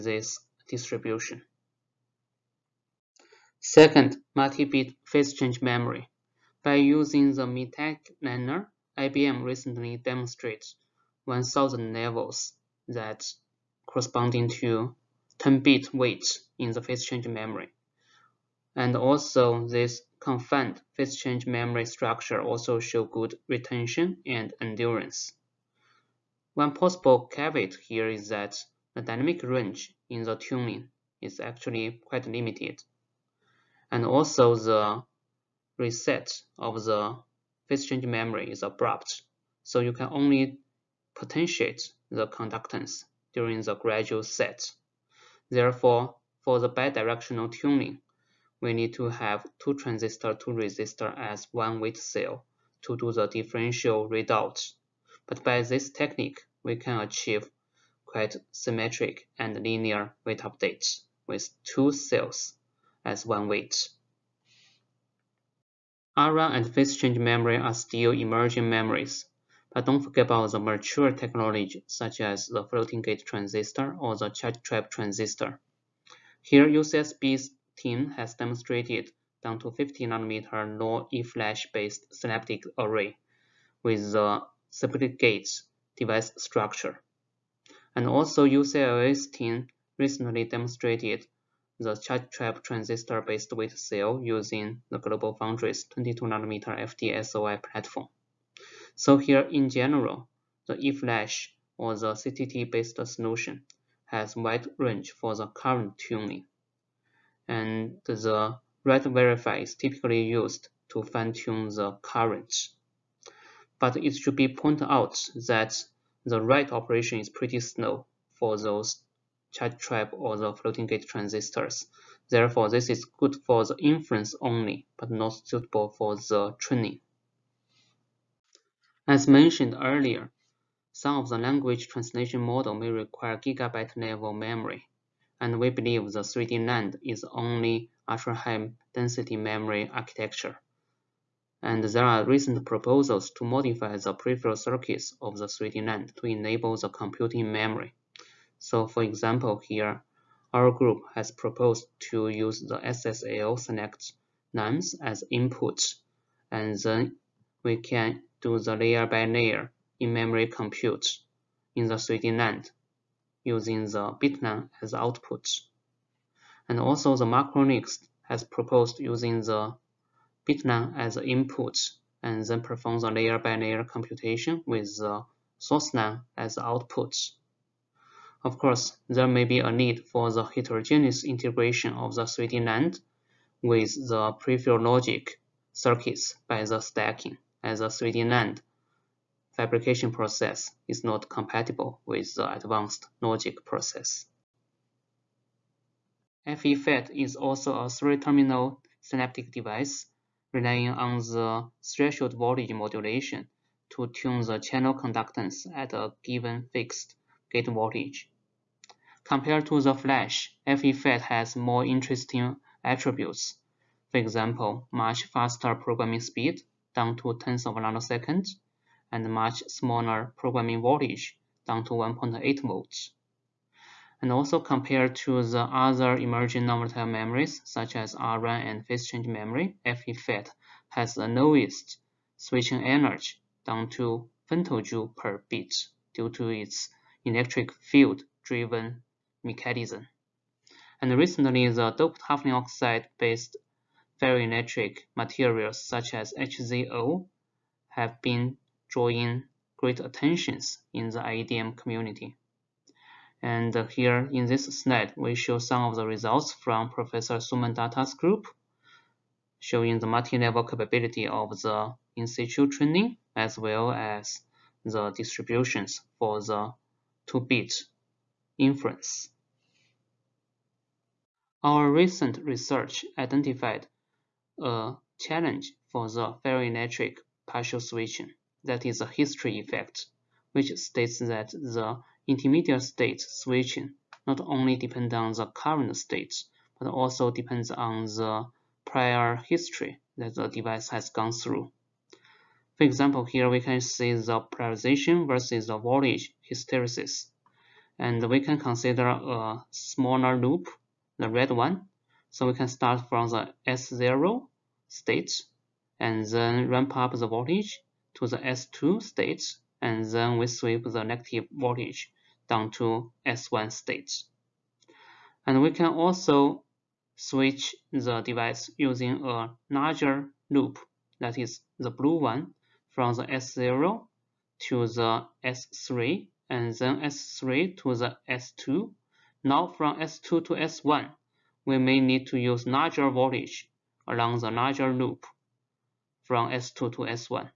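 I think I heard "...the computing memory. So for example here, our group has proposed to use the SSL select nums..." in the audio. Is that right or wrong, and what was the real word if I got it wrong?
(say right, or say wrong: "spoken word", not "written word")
right.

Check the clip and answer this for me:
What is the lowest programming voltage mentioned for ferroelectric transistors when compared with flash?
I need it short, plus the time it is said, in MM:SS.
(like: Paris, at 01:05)
1.8 volts, at 03:41.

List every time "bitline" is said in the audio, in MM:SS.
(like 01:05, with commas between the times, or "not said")
02:44, 02:50.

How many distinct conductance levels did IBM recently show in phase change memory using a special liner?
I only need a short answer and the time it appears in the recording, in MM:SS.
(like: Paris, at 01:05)
1000, at 00:11.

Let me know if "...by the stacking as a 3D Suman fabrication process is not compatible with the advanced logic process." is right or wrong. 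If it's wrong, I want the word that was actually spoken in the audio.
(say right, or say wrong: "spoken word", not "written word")
wrong: "NAND", not "Suman".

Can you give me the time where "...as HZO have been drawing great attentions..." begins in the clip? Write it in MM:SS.
04:06.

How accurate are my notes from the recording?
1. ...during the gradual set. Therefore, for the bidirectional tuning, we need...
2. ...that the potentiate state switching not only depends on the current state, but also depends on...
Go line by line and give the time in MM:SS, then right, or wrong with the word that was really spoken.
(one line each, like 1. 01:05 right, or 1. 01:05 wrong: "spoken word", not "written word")
1. 00:43 right
2. 04:41 wrong: "intermediate", not "potentiate".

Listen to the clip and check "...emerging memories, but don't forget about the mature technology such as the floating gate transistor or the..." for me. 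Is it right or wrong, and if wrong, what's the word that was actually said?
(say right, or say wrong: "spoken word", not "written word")
right.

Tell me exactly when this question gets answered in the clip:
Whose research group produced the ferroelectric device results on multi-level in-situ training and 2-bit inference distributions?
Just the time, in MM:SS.
04:16.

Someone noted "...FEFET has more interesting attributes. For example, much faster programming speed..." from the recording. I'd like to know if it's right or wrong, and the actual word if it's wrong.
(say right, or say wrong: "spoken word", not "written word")
right.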